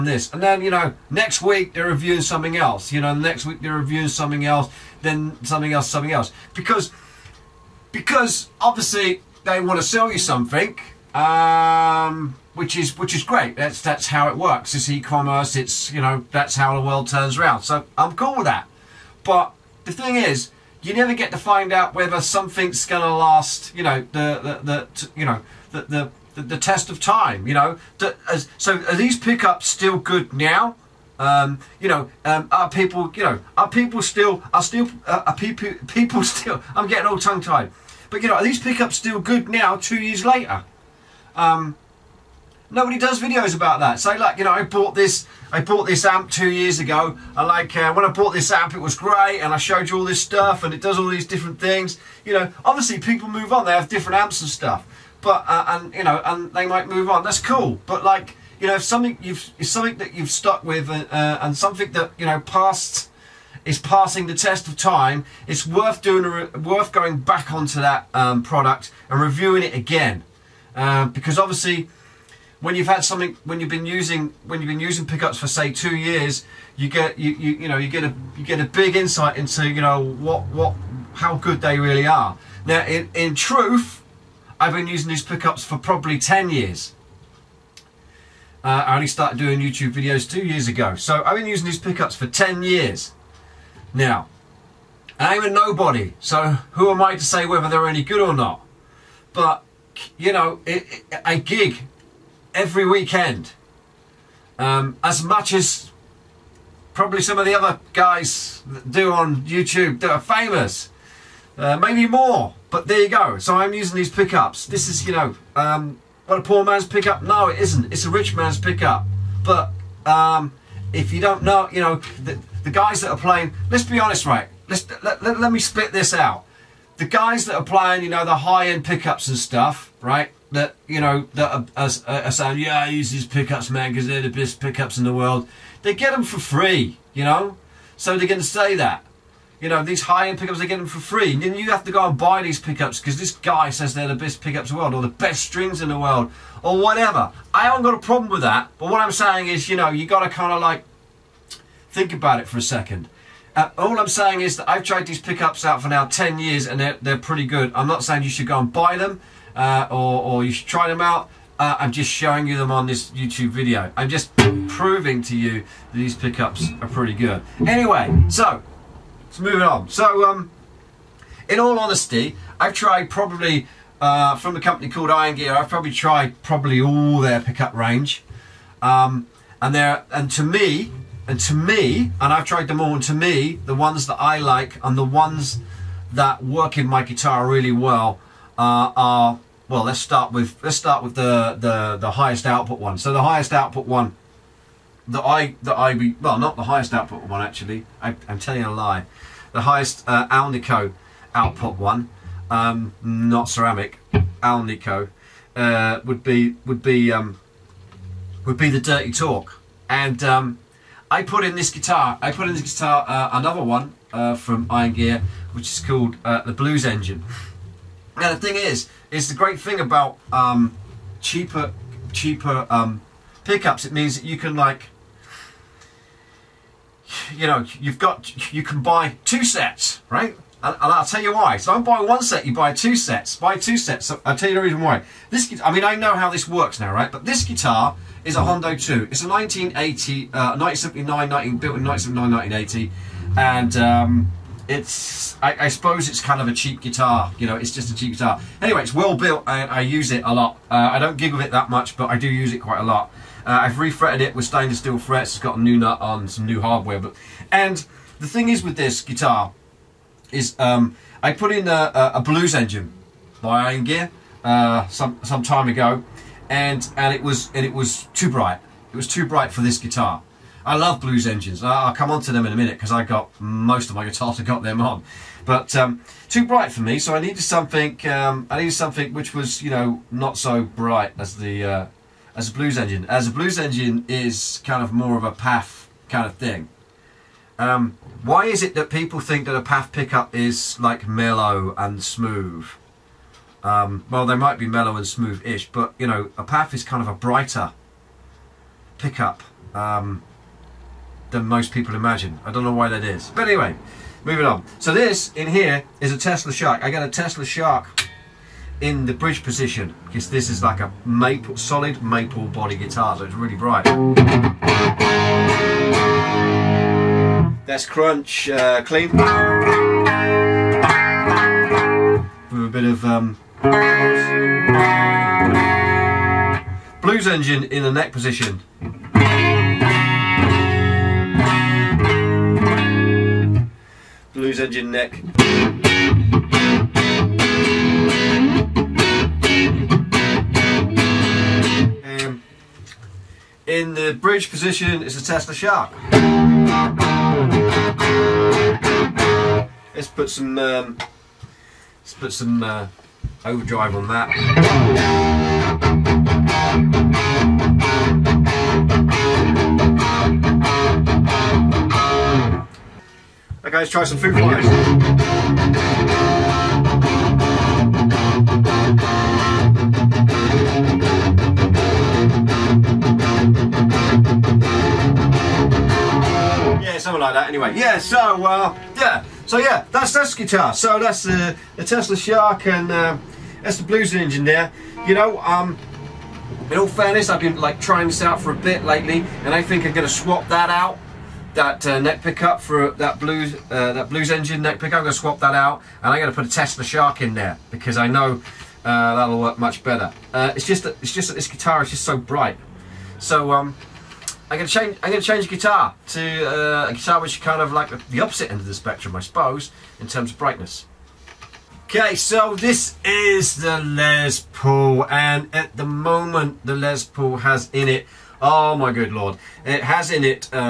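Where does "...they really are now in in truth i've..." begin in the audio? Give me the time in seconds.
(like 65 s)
81 s.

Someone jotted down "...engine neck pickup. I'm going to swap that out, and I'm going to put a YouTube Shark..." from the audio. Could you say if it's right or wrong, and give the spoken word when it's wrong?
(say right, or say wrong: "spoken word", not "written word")
wrong: "Tesla", not "YouTube".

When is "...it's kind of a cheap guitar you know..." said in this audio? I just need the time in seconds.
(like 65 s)
246 s.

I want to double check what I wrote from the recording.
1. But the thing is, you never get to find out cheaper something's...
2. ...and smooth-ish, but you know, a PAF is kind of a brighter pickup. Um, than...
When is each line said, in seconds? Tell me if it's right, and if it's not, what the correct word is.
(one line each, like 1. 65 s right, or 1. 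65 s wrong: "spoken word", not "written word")
1. 19 s wrong: "whether", not "cheaper"
2. 294 s right.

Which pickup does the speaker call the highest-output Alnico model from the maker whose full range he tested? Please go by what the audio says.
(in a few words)
Dirty Torque.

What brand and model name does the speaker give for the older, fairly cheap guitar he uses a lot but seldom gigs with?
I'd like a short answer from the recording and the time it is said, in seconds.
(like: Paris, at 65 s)
Hondo 2, at 238 s.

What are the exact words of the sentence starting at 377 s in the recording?
So uh, yeah, so yeah, that's that's guitar.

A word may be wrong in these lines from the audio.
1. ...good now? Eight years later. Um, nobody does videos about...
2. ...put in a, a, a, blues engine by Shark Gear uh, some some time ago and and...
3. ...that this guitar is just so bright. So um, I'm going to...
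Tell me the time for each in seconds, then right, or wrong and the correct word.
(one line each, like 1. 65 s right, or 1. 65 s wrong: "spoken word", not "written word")
1. 39 s wrong: "Two", not "Eight"
2. 261 s wrong: "Iron", not "Shark"
3. 401 s right.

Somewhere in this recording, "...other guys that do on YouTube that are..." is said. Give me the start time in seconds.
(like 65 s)
107 s.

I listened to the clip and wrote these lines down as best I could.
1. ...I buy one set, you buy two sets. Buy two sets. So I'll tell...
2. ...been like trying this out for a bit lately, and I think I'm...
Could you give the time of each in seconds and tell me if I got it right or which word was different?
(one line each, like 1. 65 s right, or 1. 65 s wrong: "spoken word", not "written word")
1. 231 s right
2. 387 s right.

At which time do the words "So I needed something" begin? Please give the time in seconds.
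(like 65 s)
276 s.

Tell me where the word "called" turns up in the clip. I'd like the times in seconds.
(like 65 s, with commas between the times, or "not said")
174 s, 215 s.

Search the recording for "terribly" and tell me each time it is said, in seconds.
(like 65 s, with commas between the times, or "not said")
not said.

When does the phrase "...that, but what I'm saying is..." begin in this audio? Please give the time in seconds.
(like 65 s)
148 s.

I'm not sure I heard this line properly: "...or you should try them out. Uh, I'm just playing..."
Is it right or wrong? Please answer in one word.
wrong.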